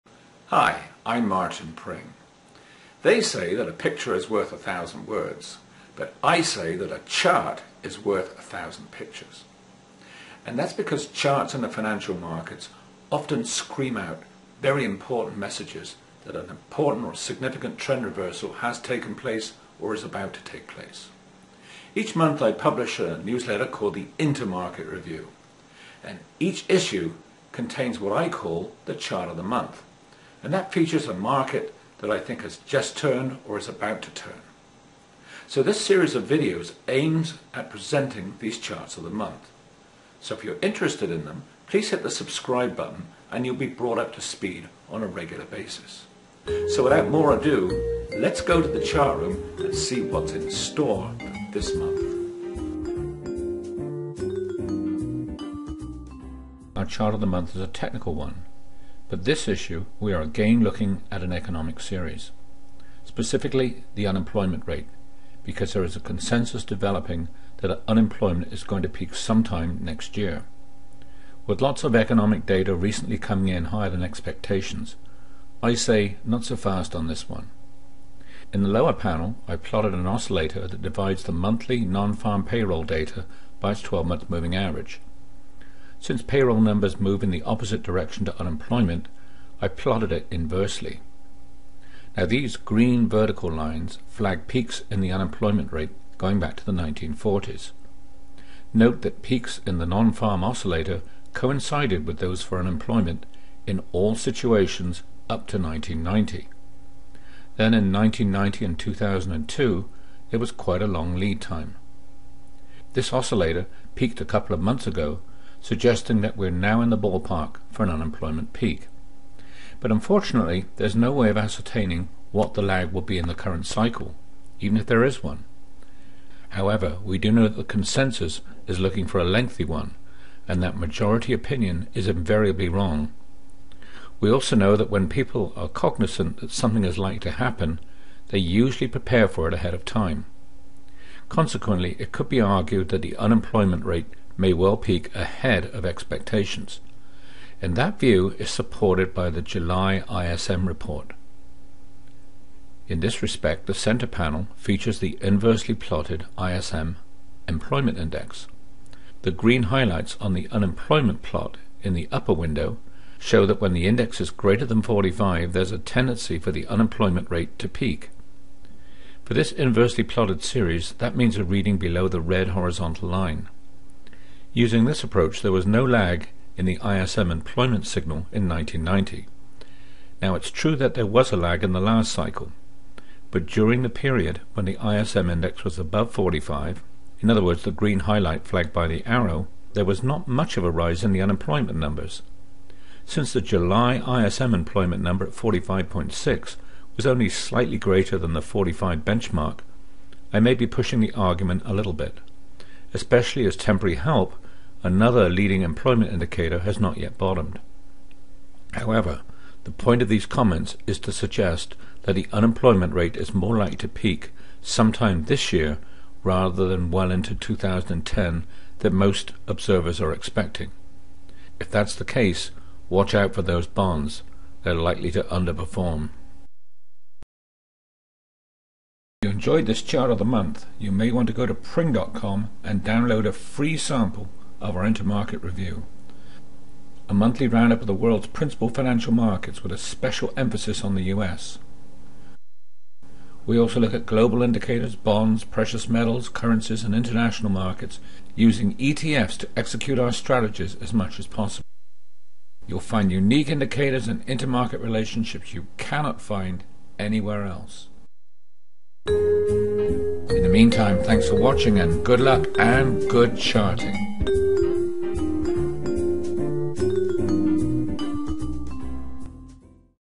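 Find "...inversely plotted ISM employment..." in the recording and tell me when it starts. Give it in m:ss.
2:35.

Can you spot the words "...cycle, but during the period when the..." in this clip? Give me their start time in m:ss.
3:02.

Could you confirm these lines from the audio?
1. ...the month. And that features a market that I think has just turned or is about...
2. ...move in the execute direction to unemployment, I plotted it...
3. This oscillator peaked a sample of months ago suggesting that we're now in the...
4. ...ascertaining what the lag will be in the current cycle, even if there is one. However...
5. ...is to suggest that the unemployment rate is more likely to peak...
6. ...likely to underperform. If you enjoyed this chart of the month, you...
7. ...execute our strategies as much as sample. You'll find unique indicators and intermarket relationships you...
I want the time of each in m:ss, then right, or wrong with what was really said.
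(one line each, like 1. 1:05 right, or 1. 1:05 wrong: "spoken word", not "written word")
1. 0:29 right
2. 1:26 wrong: "opposite", not "execute"
3. 1:52 wrong: "couple", not "sample"
4. 2:01 right
5. 3:30 right
6. 3:44 right
7. 4:09 wrong: "possible", not "sample".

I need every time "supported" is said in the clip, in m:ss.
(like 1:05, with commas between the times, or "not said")
2:28.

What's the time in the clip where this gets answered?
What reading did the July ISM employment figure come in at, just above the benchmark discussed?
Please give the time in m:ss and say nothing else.
3:15.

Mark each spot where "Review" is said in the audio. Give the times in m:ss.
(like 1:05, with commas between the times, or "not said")
0:24, 3:55.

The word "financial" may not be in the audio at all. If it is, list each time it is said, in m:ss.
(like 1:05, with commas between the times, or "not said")
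0:11, 3:58.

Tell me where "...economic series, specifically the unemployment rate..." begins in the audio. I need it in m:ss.
1:01.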